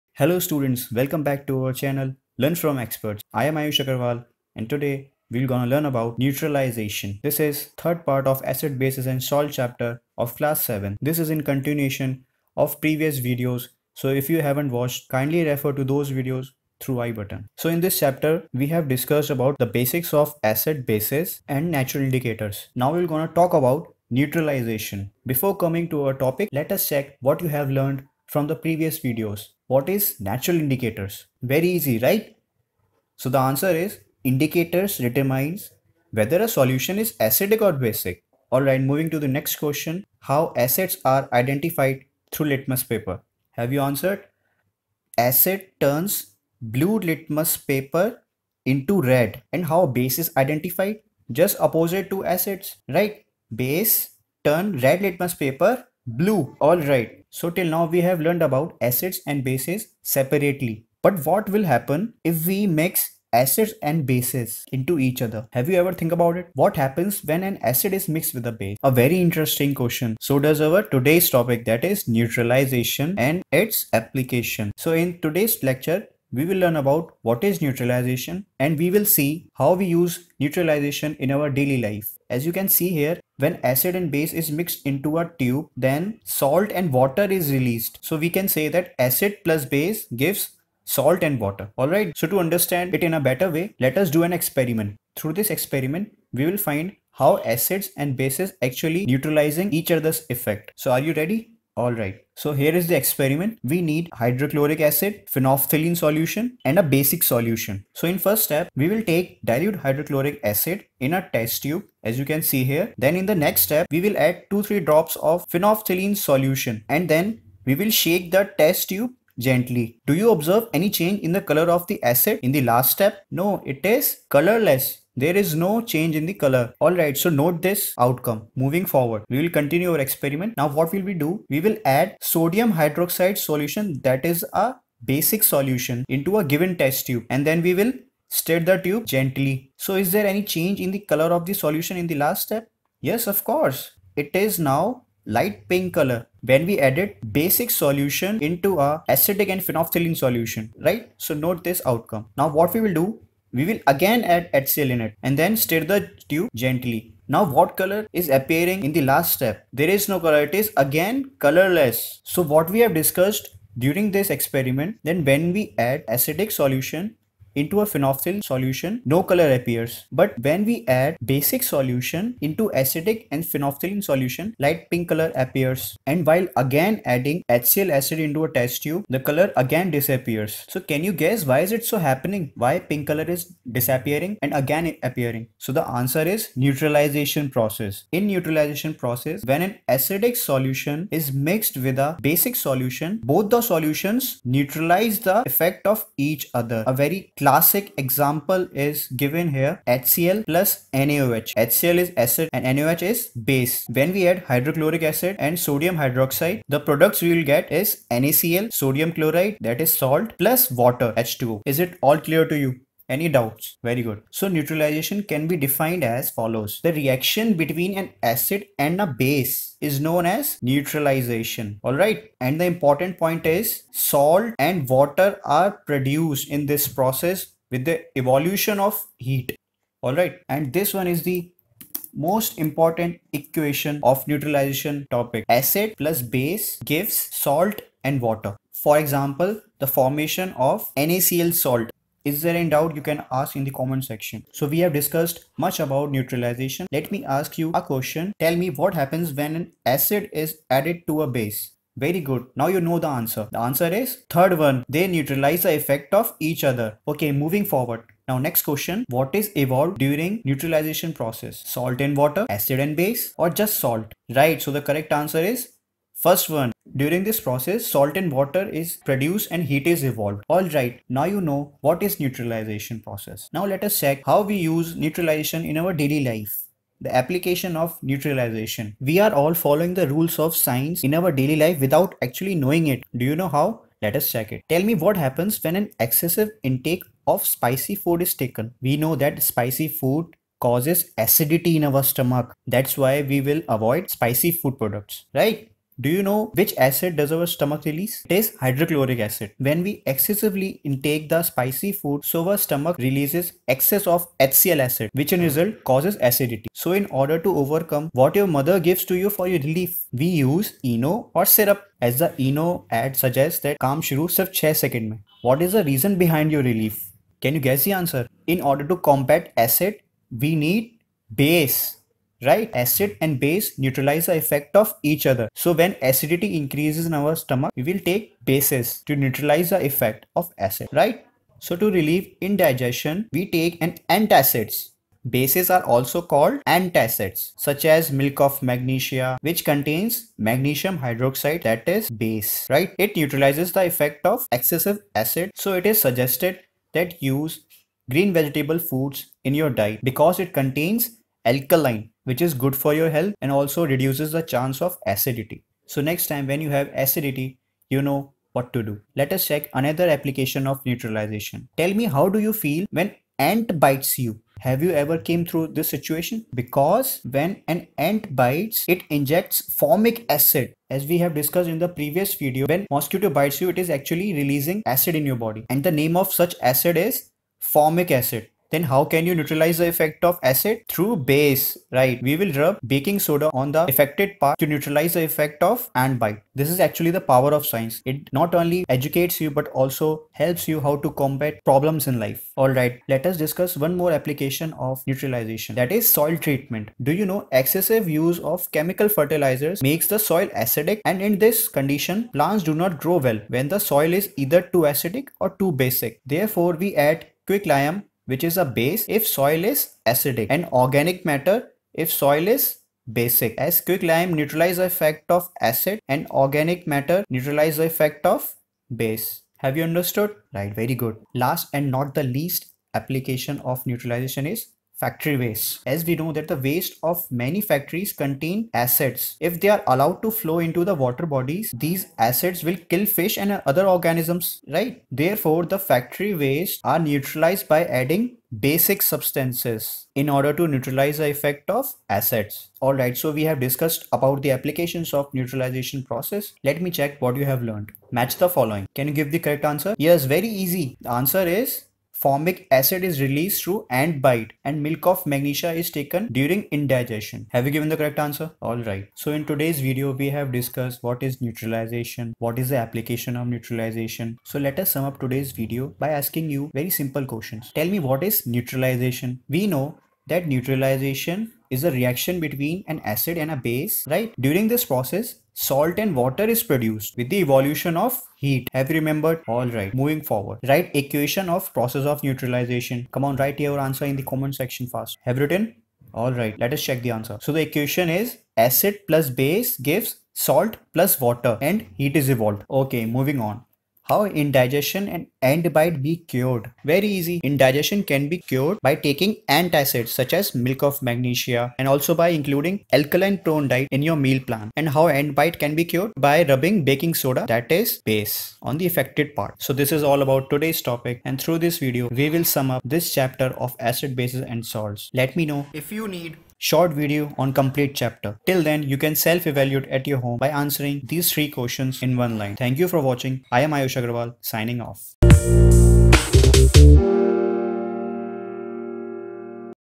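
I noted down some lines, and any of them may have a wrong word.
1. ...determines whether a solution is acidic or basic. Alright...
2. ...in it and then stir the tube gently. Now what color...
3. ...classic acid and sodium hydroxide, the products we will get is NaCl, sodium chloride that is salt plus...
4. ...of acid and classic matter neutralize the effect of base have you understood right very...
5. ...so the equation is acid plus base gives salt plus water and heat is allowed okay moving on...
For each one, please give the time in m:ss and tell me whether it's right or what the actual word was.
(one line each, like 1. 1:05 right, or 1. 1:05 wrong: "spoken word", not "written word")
1. 0:34 right
2. 2:34 right
3. 3:24 wrong: "hydrochloric", not "classic"
4. 6:55 wrong: "organic", not "classic"
5. 8:07 wrong: "evolved", not "allowed".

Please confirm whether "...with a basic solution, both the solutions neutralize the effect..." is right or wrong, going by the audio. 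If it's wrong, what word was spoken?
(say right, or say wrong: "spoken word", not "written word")
right.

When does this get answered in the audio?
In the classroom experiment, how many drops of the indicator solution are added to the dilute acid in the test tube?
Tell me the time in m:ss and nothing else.
1:54.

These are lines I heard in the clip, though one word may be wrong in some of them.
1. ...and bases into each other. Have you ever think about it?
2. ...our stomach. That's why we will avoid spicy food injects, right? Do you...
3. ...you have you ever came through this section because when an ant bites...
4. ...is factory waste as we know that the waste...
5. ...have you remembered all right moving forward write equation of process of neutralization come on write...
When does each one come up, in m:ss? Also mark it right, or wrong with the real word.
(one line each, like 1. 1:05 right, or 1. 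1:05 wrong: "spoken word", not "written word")
1. 1:03 right
2. 4:51 wrong: "products", not "injects"
3. 6:04 wrong: "situation", not "section"
4. 7:04 right
5. 7:58 right.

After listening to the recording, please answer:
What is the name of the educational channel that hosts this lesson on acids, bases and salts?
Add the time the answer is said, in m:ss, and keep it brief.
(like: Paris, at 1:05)
Learn from Experts, at 0:02.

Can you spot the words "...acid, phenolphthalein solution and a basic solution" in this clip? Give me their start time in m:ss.
1:44.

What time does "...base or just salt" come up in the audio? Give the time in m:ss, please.
4:22.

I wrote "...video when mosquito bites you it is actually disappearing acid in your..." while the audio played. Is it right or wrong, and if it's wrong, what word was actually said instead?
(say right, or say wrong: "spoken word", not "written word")
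wrong: "releasing", not "disappearing".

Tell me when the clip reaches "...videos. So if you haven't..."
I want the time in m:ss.
0:13.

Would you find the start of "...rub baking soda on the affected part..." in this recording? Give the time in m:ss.
6:22.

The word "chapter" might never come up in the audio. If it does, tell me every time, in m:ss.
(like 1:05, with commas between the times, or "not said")
0:09, 0:17, 8:33, 8:37.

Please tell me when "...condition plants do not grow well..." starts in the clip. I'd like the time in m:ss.
6:41.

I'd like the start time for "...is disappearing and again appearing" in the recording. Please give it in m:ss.
3:03.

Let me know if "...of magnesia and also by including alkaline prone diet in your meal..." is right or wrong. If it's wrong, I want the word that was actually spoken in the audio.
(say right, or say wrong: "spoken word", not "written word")
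right.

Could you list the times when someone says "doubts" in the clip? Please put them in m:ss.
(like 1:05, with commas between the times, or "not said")
3:33, 4:02.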